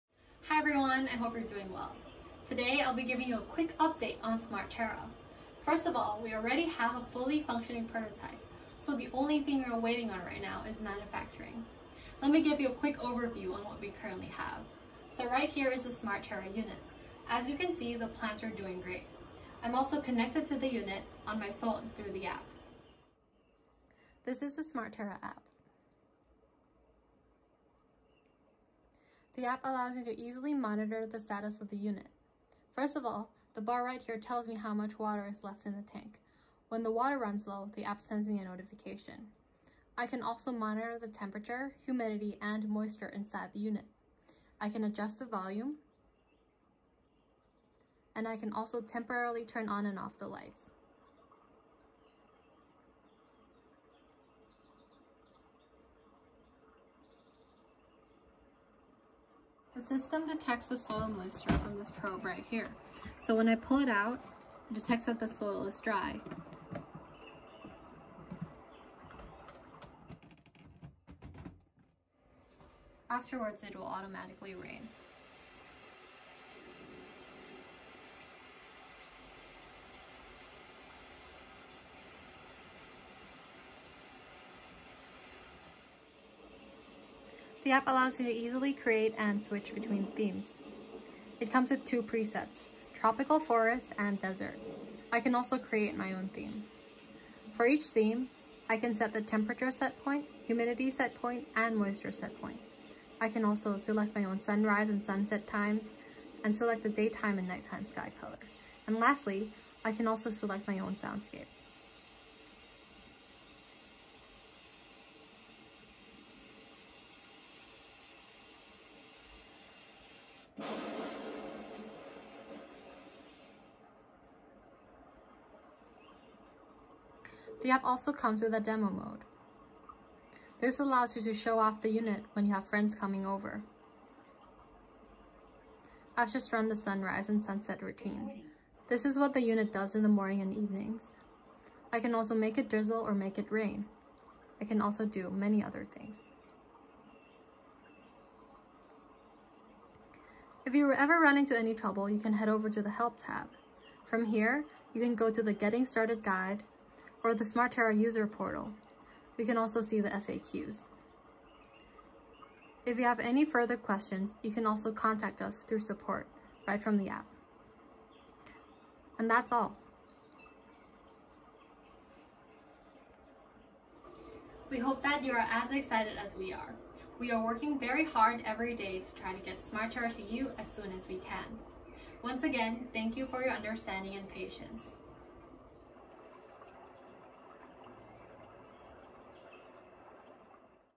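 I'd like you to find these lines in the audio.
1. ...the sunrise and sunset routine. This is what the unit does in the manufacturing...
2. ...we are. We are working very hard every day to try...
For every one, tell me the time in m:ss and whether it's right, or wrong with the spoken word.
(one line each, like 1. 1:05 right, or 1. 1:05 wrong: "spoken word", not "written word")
1. 2:16 wrong: "morning", not "manufacturing"
2. 2:56 right.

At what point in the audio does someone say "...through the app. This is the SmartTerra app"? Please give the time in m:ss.
0:21.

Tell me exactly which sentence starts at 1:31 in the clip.
It comes with two presets, tropical forest and desert.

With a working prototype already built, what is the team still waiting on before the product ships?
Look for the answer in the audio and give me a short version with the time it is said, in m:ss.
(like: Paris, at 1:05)
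Manufacturing, at 0:10.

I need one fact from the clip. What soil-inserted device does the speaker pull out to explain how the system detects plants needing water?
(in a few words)
Probe.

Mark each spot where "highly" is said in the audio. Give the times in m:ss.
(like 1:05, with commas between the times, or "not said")
not said.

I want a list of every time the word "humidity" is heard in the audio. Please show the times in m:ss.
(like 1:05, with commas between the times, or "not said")
0:41, 1:40.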